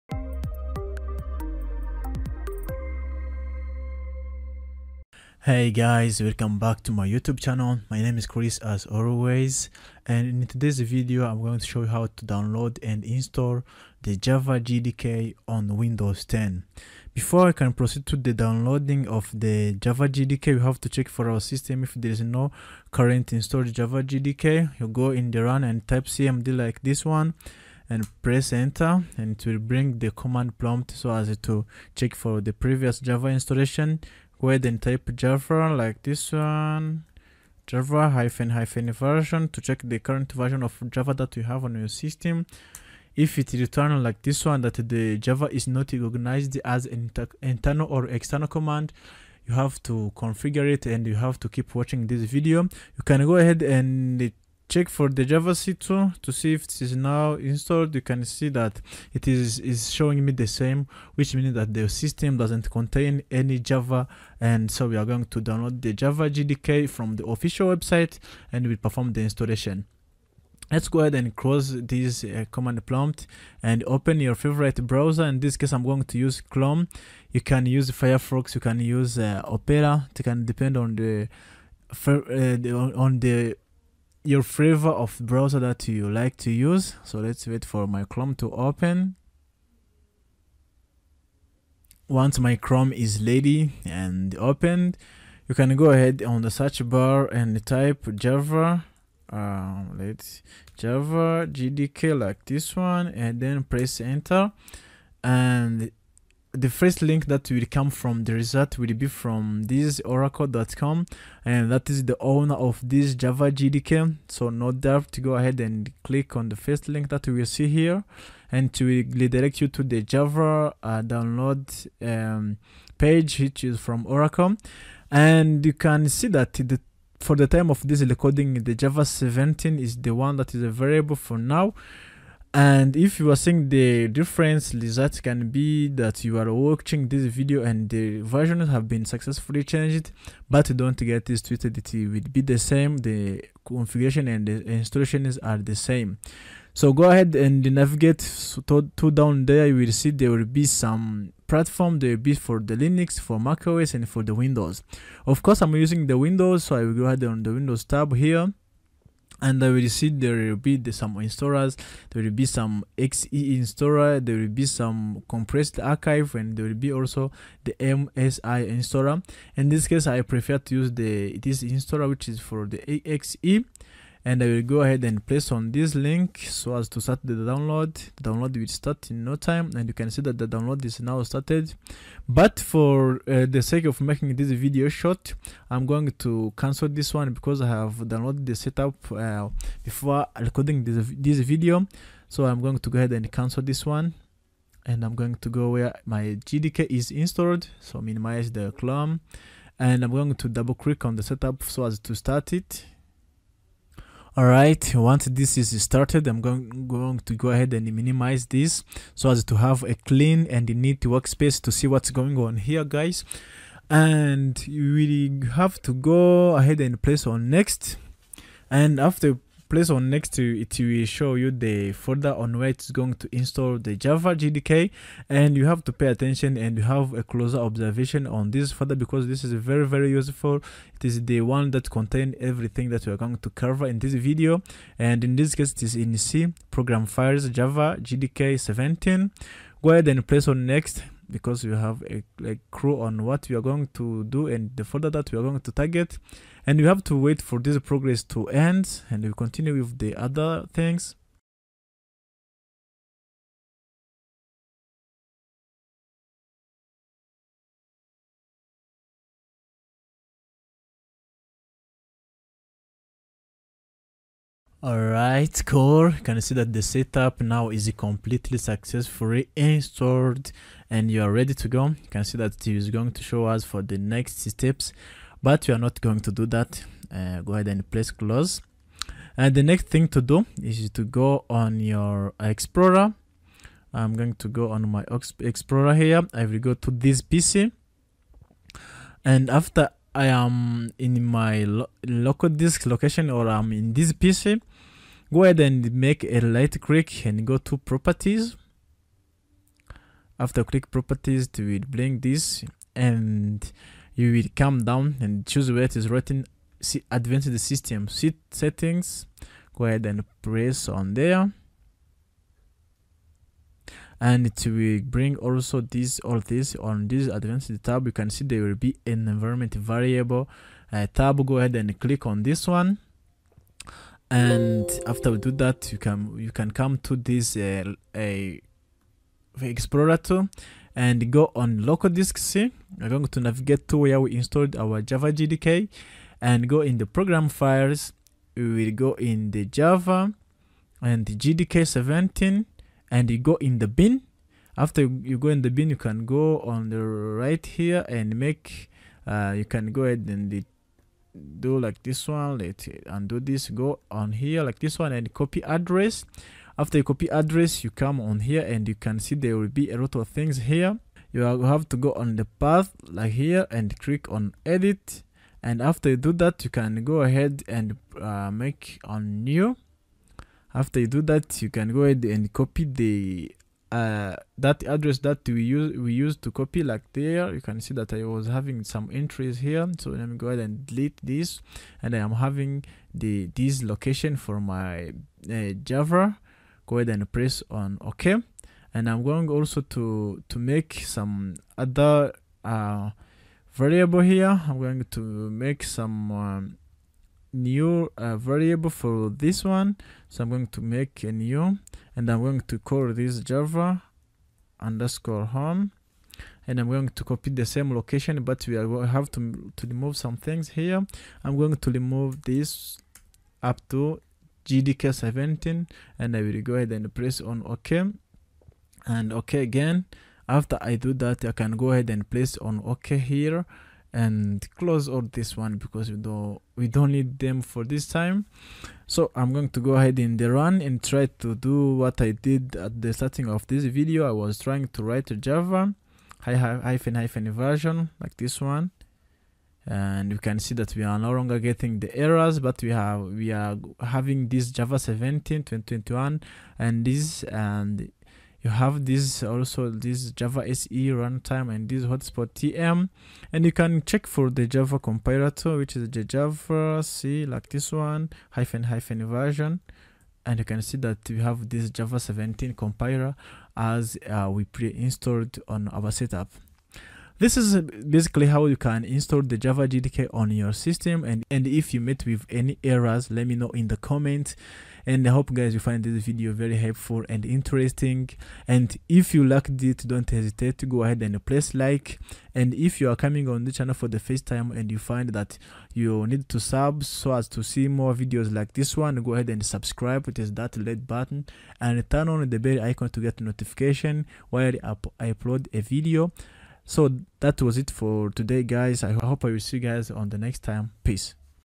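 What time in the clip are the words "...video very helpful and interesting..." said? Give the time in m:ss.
7:56.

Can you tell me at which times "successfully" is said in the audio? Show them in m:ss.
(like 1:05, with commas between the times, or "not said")
2:19, 4:28.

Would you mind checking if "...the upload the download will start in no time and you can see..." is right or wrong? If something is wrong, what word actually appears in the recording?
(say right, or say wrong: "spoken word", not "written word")
wrong: "download", not "upload".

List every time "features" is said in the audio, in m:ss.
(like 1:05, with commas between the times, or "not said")
not said.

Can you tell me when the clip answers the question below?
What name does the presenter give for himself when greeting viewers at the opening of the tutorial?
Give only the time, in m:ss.
0:08.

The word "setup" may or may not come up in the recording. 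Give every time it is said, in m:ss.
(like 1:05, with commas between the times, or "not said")
3:08, 3:21, 4:26, 7:46.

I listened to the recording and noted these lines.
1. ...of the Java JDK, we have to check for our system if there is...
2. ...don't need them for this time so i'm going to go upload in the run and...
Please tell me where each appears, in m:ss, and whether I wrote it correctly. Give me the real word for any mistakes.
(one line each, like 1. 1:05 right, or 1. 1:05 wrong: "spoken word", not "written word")
1. 0:19 right
2. 7:06 wrong: "ahead", not "upload".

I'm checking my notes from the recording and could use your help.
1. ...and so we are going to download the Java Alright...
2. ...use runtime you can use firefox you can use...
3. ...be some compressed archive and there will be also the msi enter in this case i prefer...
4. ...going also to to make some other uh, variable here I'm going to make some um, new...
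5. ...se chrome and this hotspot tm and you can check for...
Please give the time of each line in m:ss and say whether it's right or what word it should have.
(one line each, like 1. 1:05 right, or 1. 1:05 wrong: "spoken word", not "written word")
1. 1:04 wrong: "JDK", not "Alright"
2. 1:16 wrong: "chrome", not "runtime"
3. 2:44 wrong: "installer", not "enter"
4. 6:29 right
5. 7:30 wrong: "runtime", not "chrome".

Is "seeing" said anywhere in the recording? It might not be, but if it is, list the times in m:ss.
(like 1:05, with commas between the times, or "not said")
2:13.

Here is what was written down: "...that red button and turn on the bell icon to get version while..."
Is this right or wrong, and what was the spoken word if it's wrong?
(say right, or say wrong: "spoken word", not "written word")
wrong: "notification", not "version".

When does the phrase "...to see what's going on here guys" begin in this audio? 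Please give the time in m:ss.
3:31.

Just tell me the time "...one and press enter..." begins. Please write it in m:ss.
0:27.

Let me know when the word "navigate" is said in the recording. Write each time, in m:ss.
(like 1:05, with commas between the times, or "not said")
2:27, 5:33.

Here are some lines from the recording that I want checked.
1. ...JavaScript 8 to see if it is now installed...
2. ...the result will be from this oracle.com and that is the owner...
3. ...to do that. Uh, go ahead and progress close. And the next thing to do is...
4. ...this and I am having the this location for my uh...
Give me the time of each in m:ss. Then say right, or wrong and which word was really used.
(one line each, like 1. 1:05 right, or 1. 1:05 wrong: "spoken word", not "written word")
1. 0:55 wrong: "2", not "8"
2. 1:48 right
3. 4:36 wrong: "press", not "progress"
4. 6:21 right.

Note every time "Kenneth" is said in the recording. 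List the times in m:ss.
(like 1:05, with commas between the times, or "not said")
not said.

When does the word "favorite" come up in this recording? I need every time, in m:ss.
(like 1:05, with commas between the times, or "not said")
1:14, 1:24.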